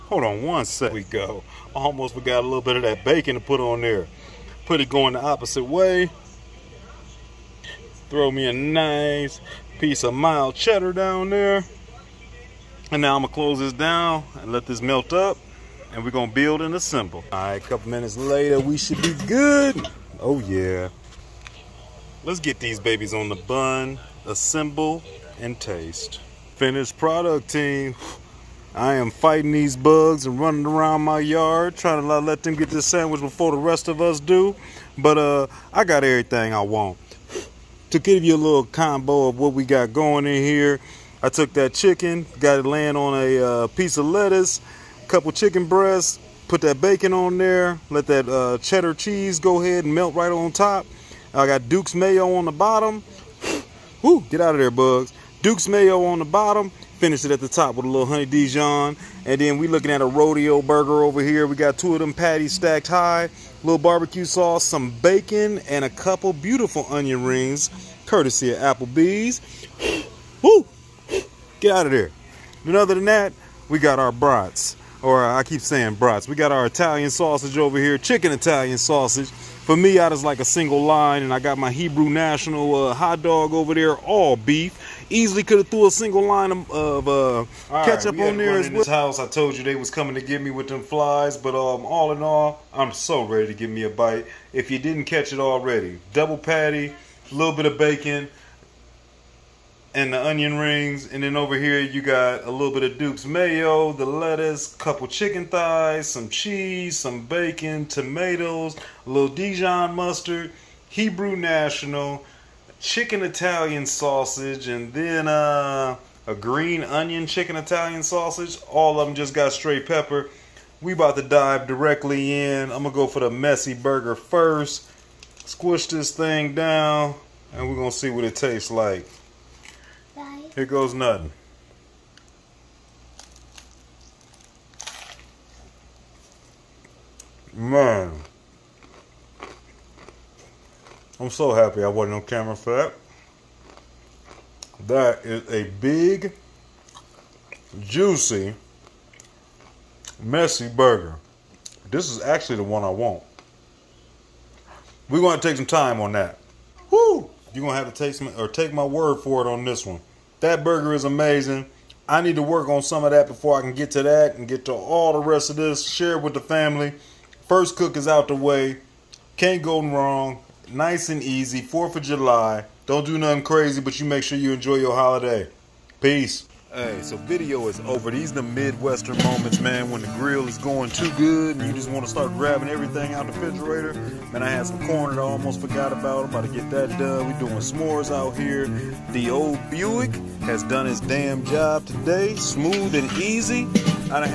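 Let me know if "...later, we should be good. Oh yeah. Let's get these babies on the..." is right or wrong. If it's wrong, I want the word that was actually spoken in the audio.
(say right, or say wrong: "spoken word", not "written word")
right.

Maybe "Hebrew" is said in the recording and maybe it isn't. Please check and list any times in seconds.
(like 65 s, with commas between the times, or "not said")
81 s, 110 s.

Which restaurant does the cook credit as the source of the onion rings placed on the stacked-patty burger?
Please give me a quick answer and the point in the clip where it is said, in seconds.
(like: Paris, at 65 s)
Applebee's, at 68 s.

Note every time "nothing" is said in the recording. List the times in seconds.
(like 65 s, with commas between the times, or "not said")
130 s, 173 s.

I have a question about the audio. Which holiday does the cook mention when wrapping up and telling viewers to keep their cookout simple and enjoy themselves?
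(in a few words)
4th of July.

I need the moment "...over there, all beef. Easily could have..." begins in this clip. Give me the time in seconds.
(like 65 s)
83 s.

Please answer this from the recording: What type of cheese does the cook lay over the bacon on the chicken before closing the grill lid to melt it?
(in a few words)
Mild cheddar.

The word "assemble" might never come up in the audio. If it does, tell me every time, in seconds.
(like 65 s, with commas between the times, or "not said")
16 s, 24 s.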